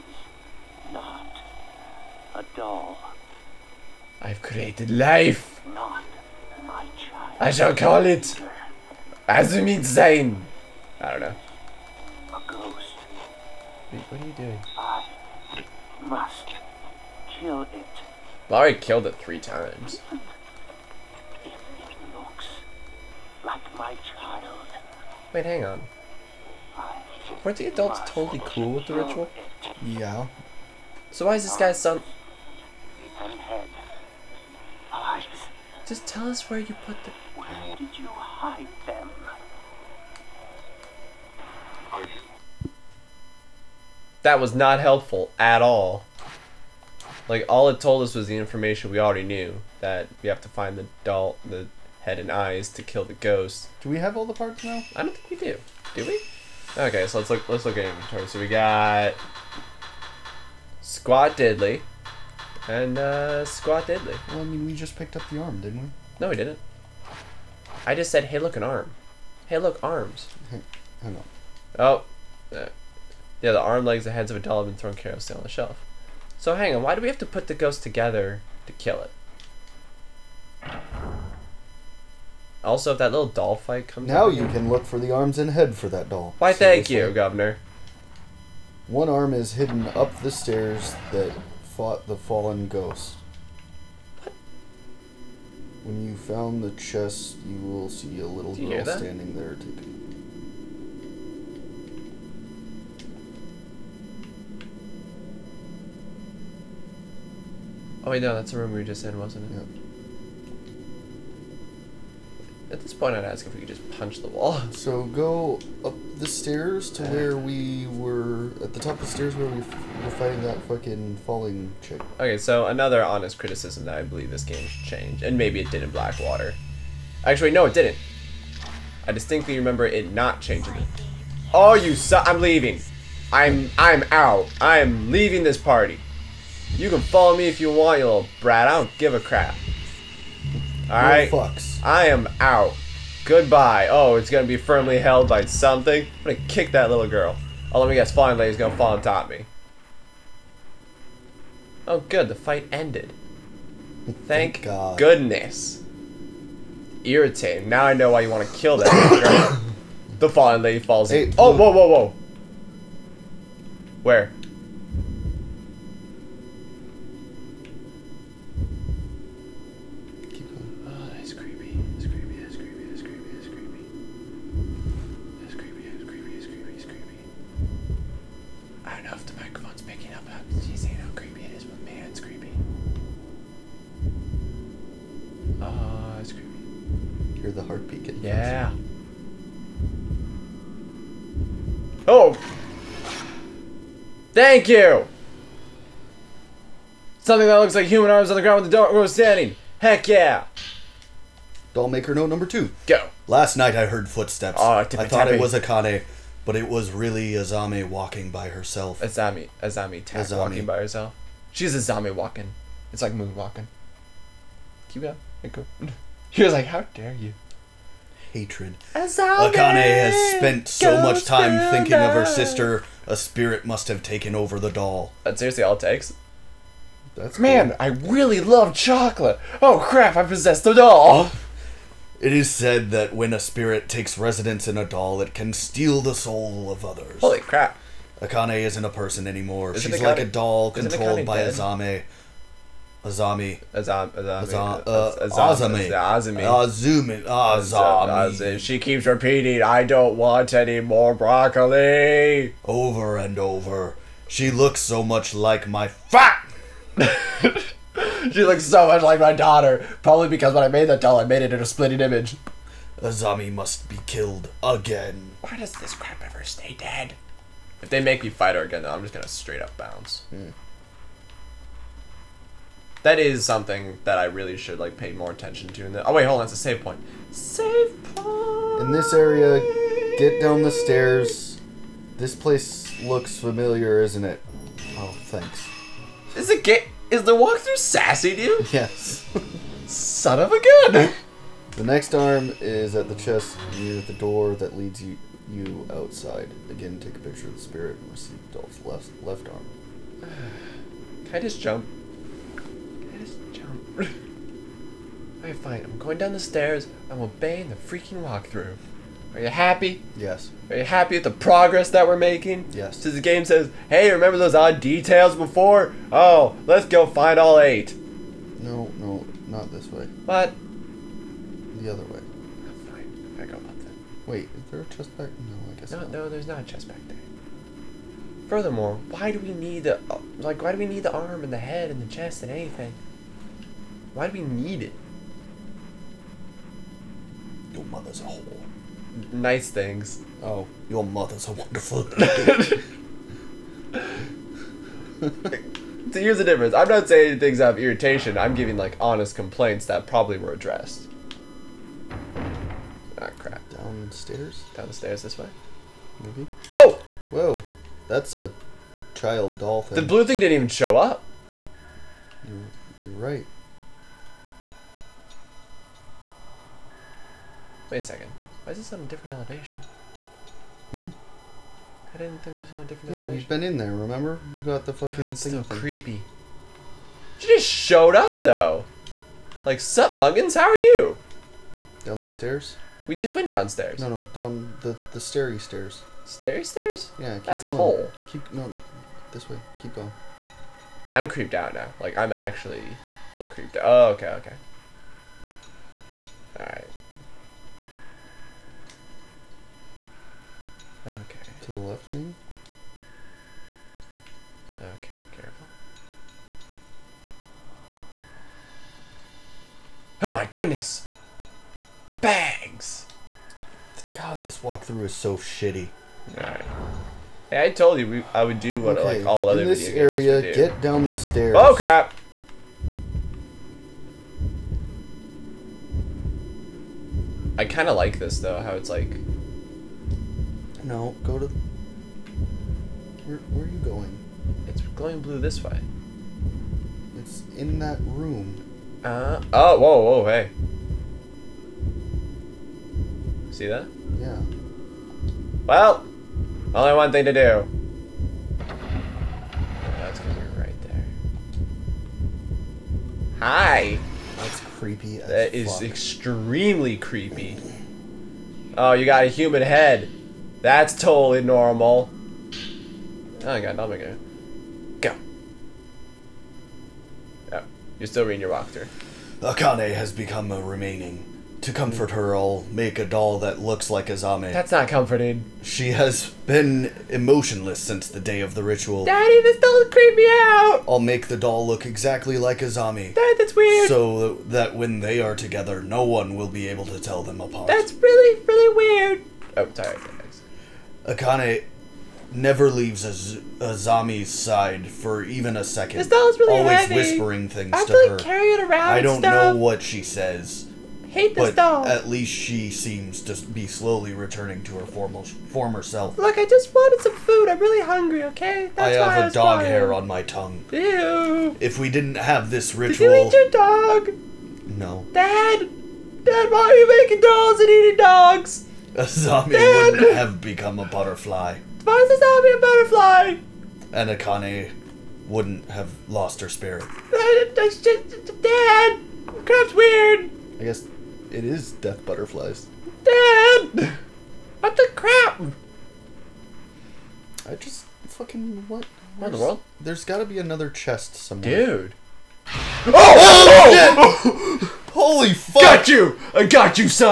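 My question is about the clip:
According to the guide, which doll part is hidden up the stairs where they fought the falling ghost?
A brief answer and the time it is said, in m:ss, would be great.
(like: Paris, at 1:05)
One arm, at 1:28.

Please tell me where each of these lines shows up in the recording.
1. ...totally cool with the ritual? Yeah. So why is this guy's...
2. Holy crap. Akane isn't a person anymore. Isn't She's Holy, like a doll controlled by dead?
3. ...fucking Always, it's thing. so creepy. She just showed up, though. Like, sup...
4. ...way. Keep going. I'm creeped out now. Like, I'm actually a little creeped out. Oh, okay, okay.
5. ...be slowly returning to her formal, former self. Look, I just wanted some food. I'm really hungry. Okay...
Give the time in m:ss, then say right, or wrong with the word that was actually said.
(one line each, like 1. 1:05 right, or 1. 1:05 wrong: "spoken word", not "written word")
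1. 0:28 right
2. 3:57 wrong: "Akane", not "Holy"
3. 6:14 wrong: "God", not "Always"
4. 6:29 right
5. 8:23 right.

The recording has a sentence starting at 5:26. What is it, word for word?
No, there's not a chest back there.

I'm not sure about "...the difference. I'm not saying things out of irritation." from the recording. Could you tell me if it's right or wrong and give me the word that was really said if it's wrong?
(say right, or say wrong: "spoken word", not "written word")
right.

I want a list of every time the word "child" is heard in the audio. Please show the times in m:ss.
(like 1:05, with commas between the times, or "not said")
0:06, 5:59.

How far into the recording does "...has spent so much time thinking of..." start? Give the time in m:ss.
3:39.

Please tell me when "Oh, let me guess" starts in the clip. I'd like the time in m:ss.
2:27.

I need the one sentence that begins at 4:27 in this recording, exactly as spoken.
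If they make me fight her again, though, I'm just gonna straight up bounce.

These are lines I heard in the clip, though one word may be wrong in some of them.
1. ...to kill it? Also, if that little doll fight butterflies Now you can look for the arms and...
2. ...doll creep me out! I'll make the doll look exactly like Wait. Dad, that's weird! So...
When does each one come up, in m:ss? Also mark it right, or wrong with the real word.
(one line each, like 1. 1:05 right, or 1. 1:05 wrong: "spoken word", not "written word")
1. 1:18 wrong: "comes", not "butterflies"
2. 7:59 wrong: "Azami", not "Wait".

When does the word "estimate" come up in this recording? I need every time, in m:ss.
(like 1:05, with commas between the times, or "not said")
not said.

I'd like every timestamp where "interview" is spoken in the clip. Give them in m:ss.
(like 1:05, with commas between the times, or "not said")
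not said.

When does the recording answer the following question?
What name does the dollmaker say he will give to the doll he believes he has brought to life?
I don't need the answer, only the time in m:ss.
0:09.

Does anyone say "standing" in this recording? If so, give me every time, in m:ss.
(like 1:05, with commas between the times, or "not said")
1:38, 3:19.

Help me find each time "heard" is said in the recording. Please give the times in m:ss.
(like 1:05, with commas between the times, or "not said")
3:23.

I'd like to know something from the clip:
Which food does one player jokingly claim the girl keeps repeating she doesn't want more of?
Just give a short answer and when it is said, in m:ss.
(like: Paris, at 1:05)
broccoli, at 4:11.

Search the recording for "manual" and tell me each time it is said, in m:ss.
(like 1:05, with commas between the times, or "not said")
not said.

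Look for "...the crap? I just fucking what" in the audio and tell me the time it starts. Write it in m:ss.
8:54.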